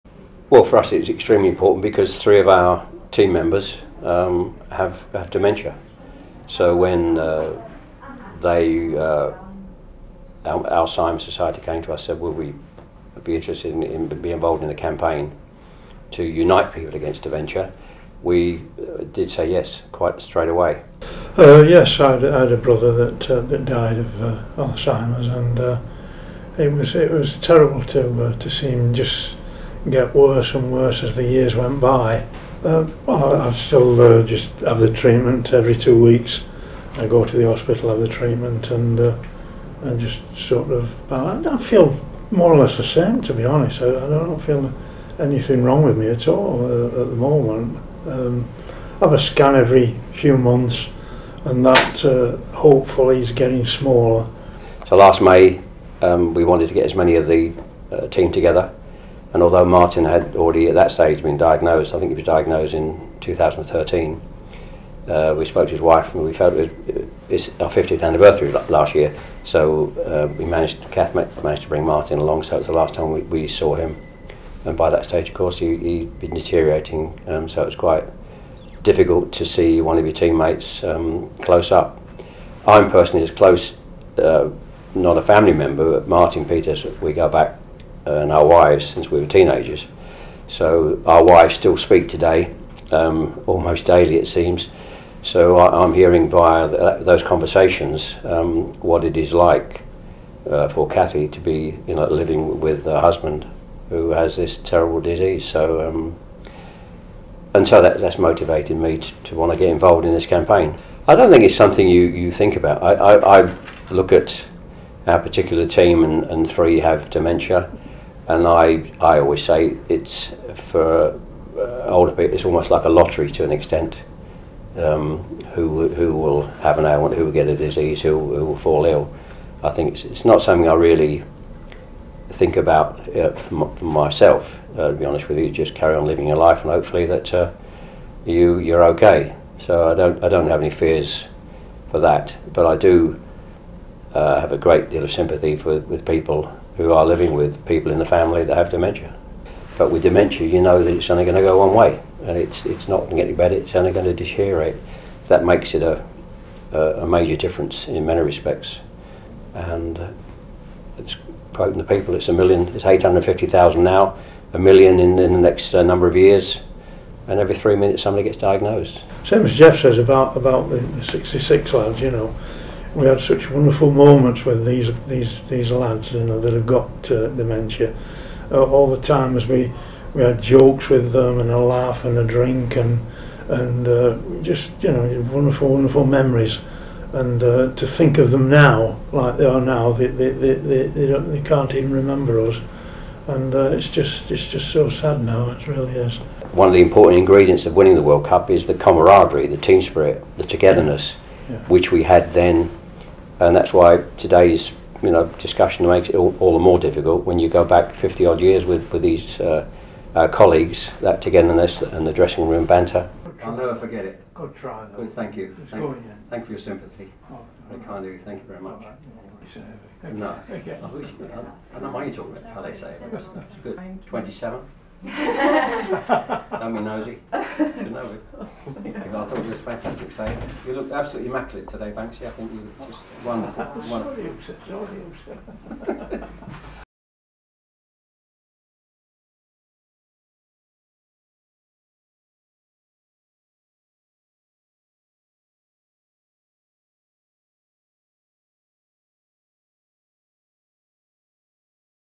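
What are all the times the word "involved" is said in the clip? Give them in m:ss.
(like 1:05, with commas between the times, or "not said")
0:14, 1:49.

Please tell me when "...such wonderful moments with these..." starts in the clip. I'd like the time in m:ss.
2:53.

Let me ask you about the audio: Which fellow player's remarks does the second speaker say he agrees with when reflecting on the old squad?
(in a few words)
Geoff.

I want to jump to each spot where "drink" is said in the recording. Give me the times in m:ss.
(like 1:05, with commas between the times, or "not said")
3:02.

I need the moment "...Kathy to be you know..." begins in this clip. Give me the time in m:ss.
1:40.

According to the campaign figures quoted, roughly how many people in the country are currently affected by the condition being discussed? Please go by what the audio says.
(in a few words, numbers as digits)
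850,000.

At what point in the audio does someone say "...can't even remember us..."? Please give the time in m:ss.
3:11.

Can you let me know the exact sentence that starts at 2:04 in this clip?
Um, who who will have an ailment, who will get a disease, who, who will fall ill.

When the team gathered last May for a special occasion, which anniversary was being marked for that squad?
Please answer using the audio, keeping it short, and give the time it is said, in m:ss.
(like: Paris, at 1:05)
50th, at 1:07.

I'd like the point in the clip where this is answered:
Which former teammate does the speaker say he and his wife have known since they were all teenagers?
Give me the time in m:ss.
1:26.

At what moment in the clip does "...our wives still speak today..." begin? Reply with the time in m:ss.
1:31.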